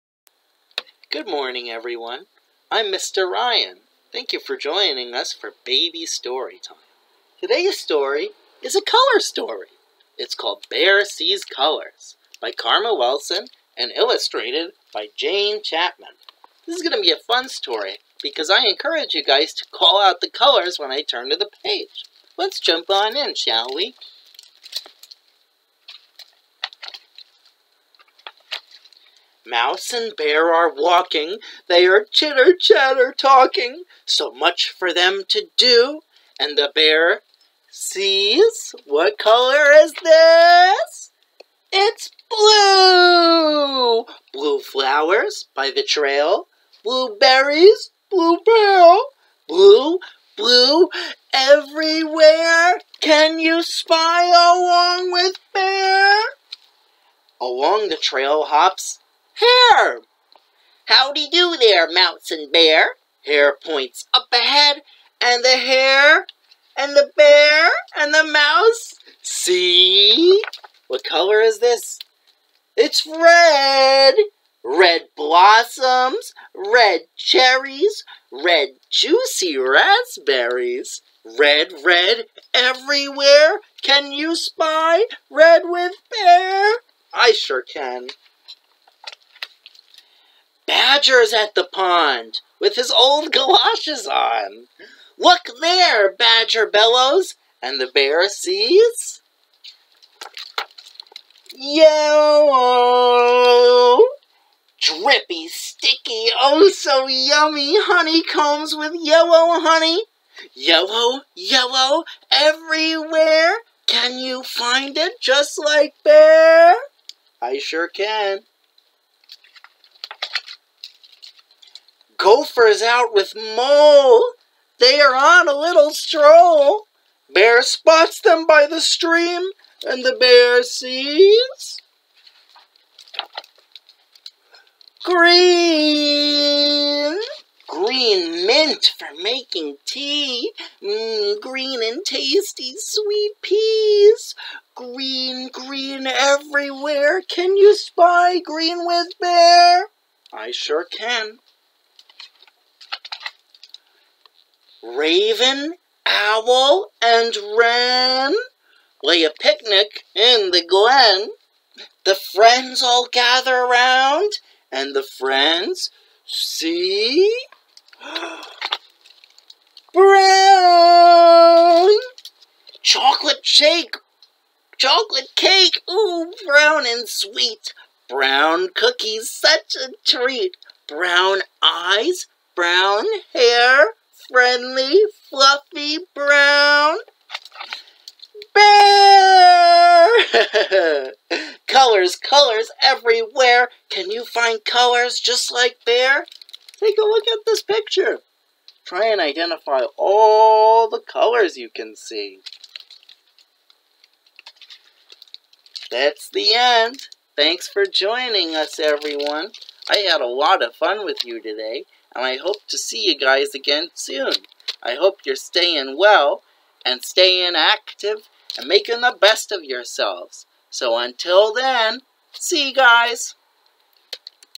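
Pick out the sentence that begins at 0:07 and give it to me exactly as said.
Today's story is a color story.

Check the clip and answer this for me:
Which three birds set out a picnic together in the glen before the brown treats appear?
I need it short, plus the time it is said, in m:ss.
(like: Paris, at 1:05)
Raven, Owl, and Wren, at 2:34.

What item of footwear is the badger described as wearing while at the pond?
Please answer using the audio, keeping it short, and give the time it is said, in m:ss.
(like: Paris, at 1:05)
galoshes, at 1:33.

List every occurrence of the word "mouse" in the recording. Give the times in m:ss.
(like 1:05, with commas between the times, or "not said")
0:29, 1:08.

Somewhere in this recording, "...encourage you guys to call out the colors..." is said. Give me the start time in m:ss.
0:18.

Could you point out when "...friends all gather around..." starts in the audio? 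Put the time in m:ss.
2:42.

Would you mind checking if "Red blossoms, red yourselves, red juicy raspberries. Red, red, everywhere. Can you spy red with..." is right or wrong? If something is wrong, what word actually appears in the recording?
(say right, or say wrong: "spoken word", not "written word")
wrong: "cherries", not "yourselves".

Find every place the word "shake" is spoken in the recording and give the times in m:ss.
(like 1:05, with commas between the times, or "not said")
2:53.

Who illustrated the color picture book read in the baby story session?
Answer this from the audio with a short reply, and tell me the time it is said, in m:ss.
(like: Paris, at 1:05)
Jane Chapman, at 0:15.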